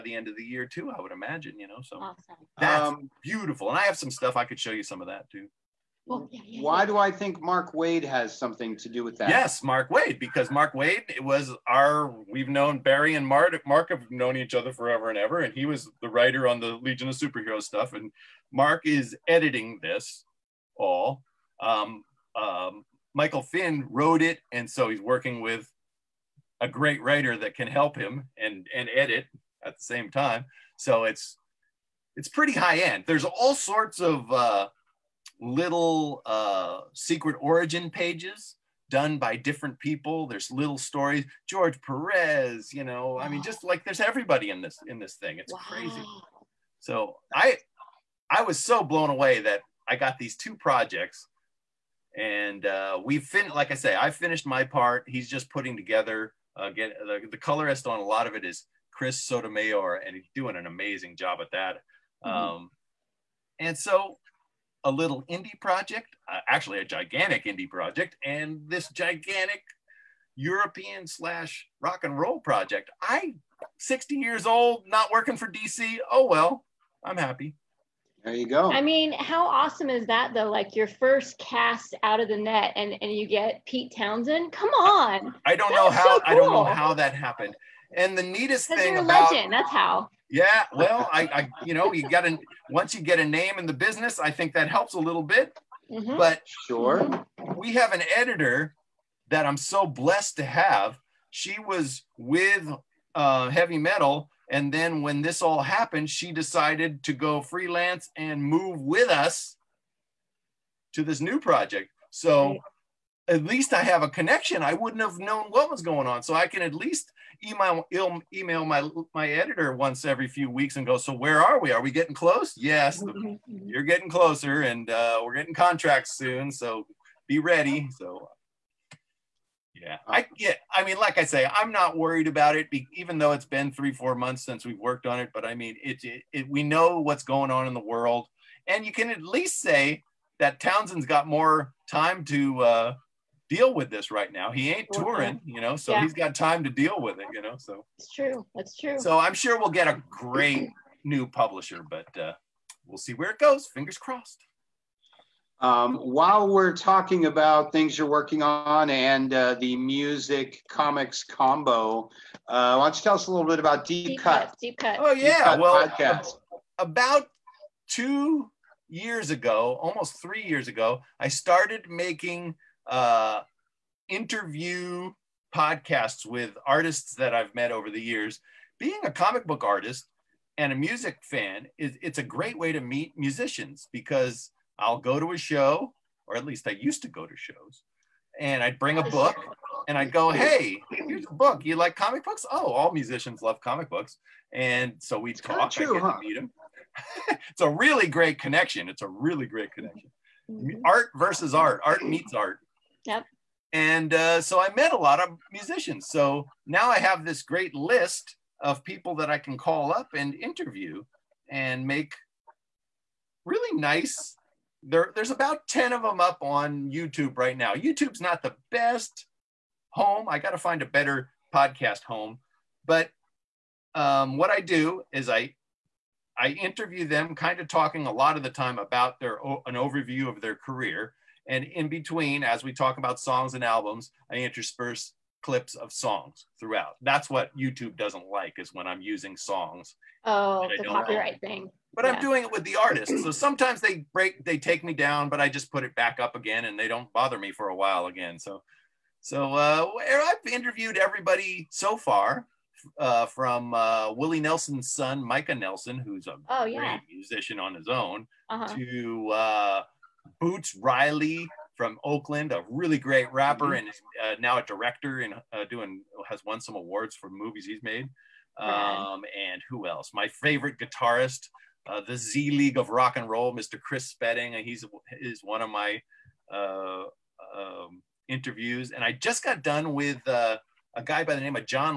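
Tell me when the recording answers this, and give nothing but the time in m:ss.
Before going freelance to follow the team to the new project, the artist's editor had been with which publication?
1:43.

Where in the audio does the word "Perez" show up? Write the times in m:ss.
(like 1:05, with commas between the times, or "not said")
0:41.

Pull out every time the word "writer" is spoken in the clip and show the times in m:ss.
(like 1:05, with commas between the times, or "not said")
0:16, 0:27.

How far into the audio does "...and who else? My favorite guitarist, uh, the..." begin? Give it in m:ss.
4:29.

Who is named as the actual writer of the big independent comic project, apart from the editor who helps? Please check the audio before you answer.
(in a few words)
Michael Finn.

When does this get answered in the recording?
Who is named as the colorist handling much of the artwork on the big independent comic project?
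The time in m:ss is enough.
0:58.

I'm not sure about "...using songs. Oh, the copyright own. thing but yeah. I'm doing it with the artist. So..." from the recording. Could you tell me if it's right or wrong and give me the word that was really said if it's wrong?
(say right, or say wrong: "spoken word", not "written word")
right.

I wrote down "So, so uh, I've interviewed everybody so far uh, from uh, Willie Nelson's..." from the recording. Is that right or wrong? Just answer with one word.
right.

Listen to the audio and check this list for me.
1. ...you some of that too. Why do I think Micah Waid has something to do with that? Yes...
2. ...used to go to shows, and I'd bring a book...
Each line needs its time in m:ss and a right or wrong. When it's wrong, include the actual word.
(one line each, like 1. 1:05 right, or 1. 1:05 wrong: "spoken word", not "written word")
1. 0:04 wrong: "Mark", not "Micah"
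2. 3:06 right.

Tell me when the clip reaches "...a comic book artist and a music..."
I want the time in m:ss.
2:59.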